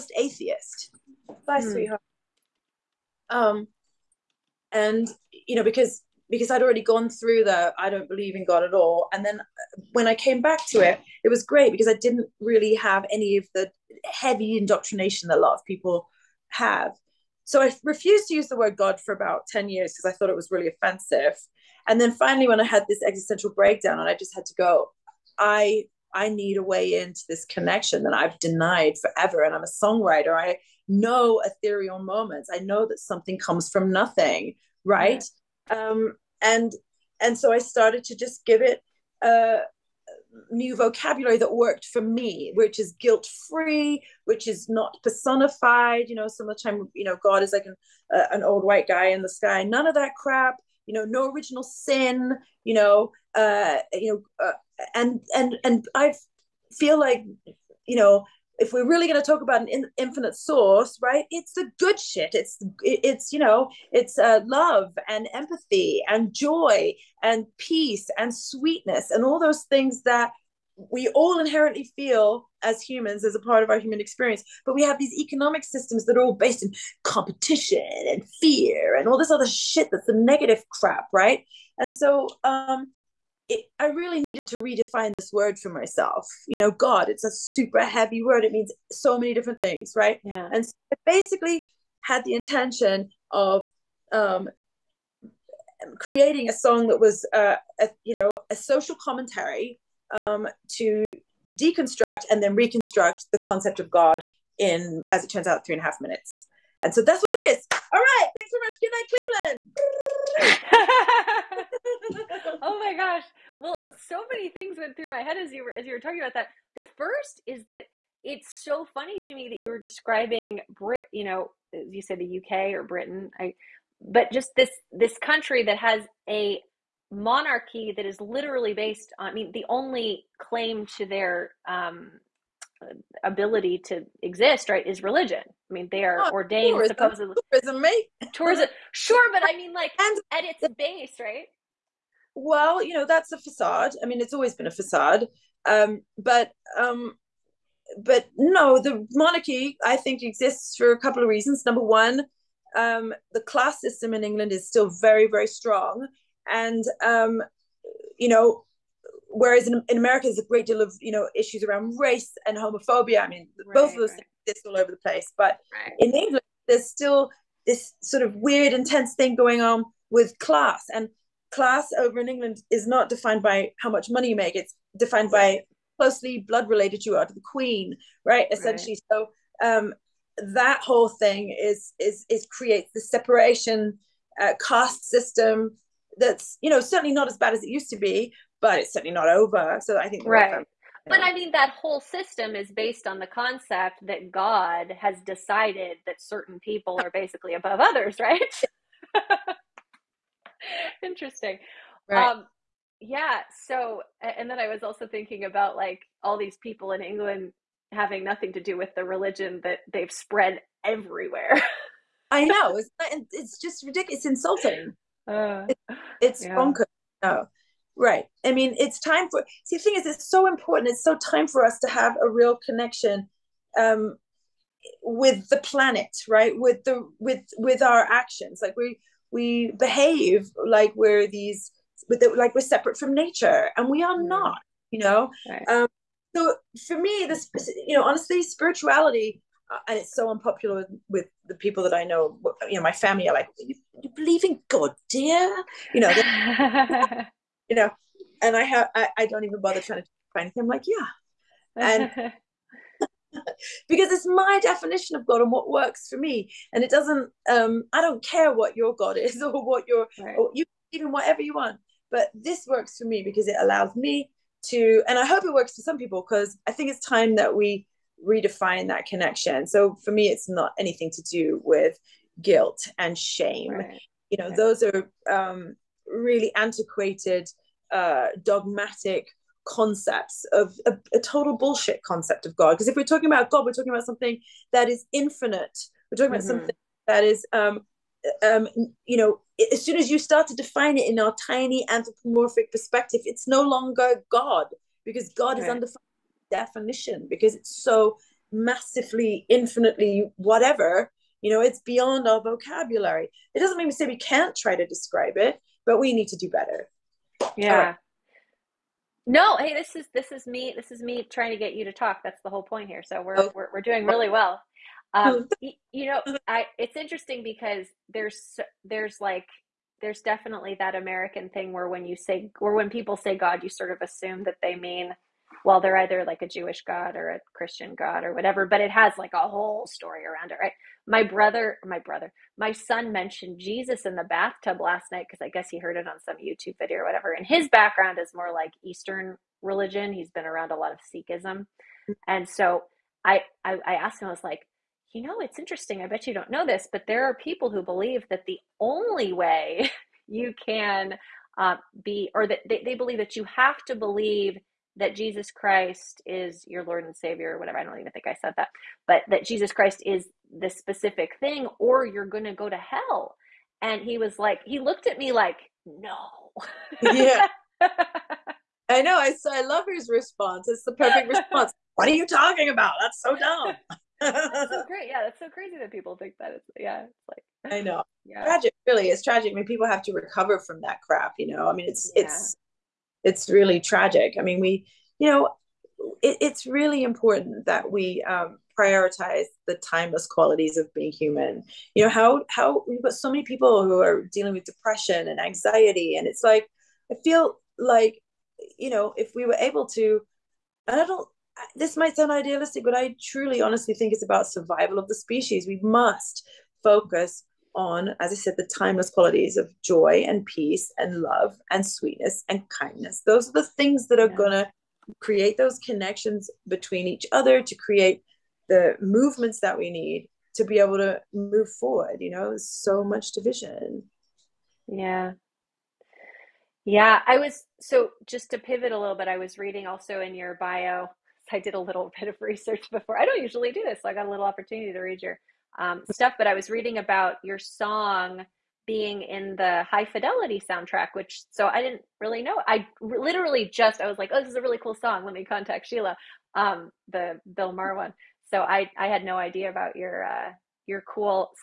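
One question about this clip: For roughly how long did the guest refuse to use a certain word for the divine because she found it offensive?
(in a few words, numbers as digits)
10 years.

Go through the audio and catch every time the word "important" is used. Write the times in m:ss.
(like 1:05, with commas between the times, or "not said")
3:40, 6:27.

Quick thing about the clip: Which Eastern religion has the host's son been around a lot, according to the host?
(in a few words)
Sikhism.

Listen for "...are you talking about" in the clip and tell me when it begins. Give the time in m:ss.
6:12.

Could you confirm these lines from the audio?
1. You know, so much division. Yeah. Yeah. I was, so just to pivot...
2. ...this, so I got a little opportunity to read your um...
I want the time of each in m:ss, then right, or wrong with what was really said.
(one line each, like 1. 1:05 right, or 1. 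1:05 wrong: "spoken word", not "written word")
1. 7:02 right
2. 7:13 right.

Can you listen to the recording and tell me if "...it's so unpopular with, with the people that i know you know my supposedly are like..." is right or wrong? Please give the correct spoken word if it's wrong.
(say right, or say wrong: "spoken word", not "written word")
wrong: "family", not "supposedly".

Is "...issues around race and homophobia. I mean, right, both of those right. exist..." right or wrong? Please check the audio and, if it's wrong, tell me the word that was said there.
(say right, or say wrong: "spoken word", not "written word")
right.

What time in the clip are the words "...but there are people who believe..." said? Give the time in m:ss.
5:46.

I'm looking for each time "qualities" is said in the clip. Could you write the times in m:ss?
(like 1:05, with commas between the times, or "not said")
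6:30, 6:49.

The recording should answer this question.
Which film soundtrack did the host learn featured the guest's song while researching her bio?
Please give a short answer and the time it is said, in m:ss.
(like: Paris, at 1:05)
High Fidelity, at 7:19.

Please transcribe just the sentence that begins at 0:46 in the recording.
You know, some of the time, you know, God is like an uh, an old white guy in the sky.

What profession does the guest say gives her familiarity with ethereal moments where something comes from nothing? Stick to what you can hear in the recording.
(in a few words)
Songwriter.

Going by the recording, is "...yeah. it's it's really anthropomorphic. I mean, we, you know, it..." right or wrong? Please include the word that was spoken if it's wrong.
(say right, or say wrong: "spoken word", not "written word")
wrong: "tragic", not "anthropomorphic".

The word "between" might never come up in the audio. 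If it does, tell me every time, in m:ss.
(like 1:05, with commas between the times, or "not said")
6:56.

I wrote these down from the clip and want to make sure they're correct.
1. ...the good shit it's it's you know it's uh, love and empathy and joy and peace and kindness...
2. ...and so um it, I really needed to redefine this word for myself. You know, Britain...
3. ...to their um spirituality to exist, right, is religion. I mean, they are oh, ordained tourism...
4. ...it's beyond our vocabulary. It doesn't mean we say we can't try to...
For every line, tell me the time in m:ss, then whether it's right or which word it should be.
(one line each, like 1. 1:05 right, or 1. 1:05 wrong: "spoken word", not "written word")
1. 1:01 wrong: "sweetness", not "kindness"
2. 1:21 wrong: "God", not "Britain"
3. 2:10 wrong: "ability", not "spirituality"
4. 5:01 right.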